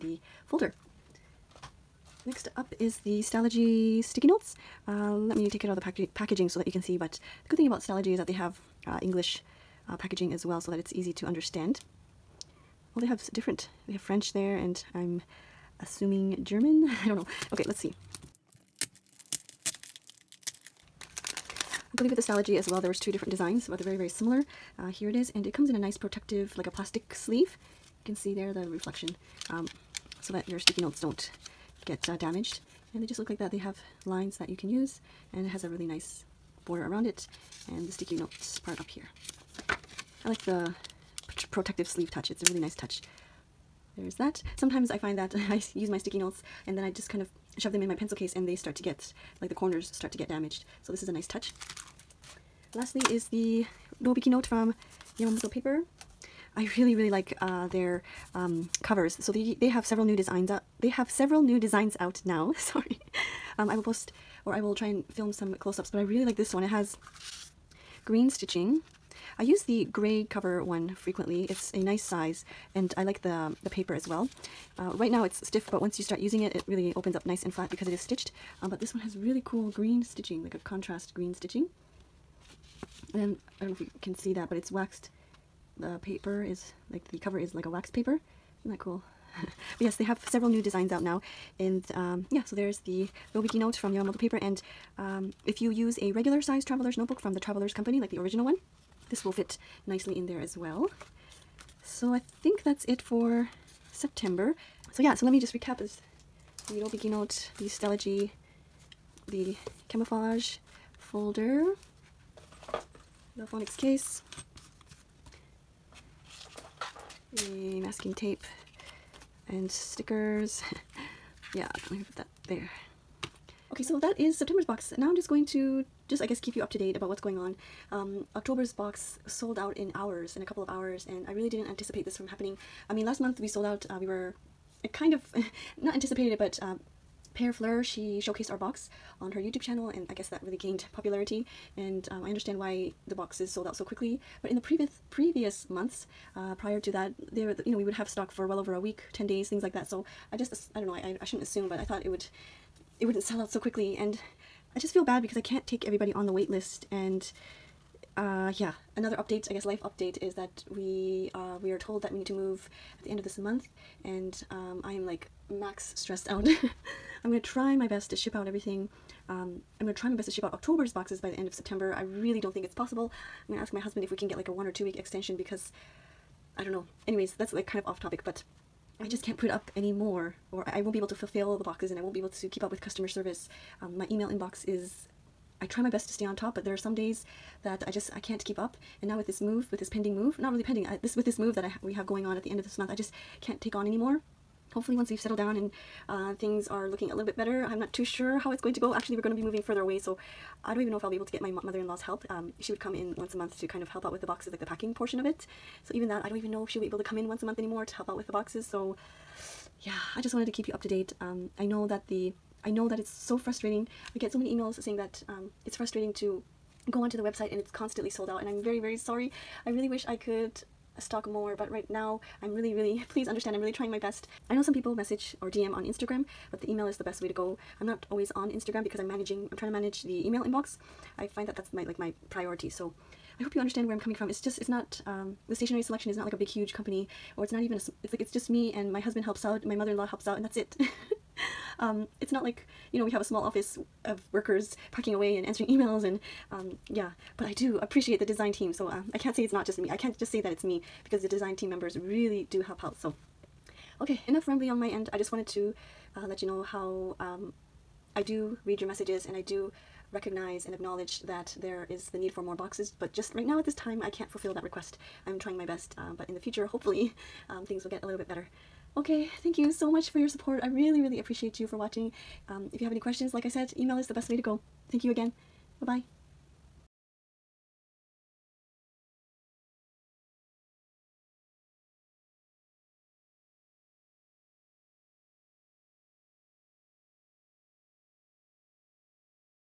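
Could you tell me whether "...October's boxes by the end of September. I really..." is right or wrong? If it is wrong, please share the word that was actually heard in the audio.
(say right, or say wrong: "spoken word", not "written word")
right.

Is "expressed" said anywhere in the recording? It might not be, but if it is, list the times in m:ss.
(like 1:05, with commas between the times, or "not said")
not said.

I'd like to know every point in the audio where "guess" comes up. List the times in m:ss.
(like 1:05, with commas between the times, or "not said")
2:06, 2:20, 2:39.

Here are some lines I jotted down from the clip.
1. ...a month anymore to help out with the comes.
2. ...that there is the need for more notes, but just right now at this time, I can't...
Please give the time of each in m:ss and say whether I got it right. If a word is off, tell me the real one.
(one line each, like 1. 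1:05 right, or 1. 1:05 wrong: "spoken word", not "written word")
1. 3:27 wrong: "boxes", not "comes"
2. 4:21 wrong: "boxes", not "notes".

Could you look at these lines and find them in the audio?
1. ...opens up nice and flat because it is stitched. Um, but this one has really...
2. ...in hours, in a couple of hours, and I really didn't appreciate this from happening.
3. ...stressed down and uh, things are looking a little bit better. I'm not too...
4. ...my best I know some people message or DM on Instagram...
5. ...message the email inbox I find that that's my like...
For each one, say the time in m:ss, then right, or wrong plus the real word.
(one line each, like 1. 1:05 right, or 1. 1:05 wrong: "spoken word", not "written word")
1. 1:16 right
2. 2:09 wrong: "anticipate", not "appreciate"
3. 3:15 wrong: "settled", not "stressed"
4. 3:43 right
5. 3:49 wrong: "manage", not "message".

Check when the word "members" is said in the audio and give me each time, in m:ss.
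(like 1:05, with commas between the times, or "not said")
4:11.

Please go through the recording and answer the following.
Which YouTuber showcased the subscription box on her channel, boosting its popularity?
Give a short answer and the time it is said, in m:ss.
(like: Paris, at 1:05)
Pear Fleur, at 2:17.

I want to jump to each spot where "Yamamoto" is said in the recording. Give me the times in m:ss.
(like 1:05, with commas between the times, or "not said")
0:55, 1:33.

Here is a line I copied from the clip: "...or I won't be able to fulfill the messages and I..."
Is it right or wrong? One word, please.
wrong.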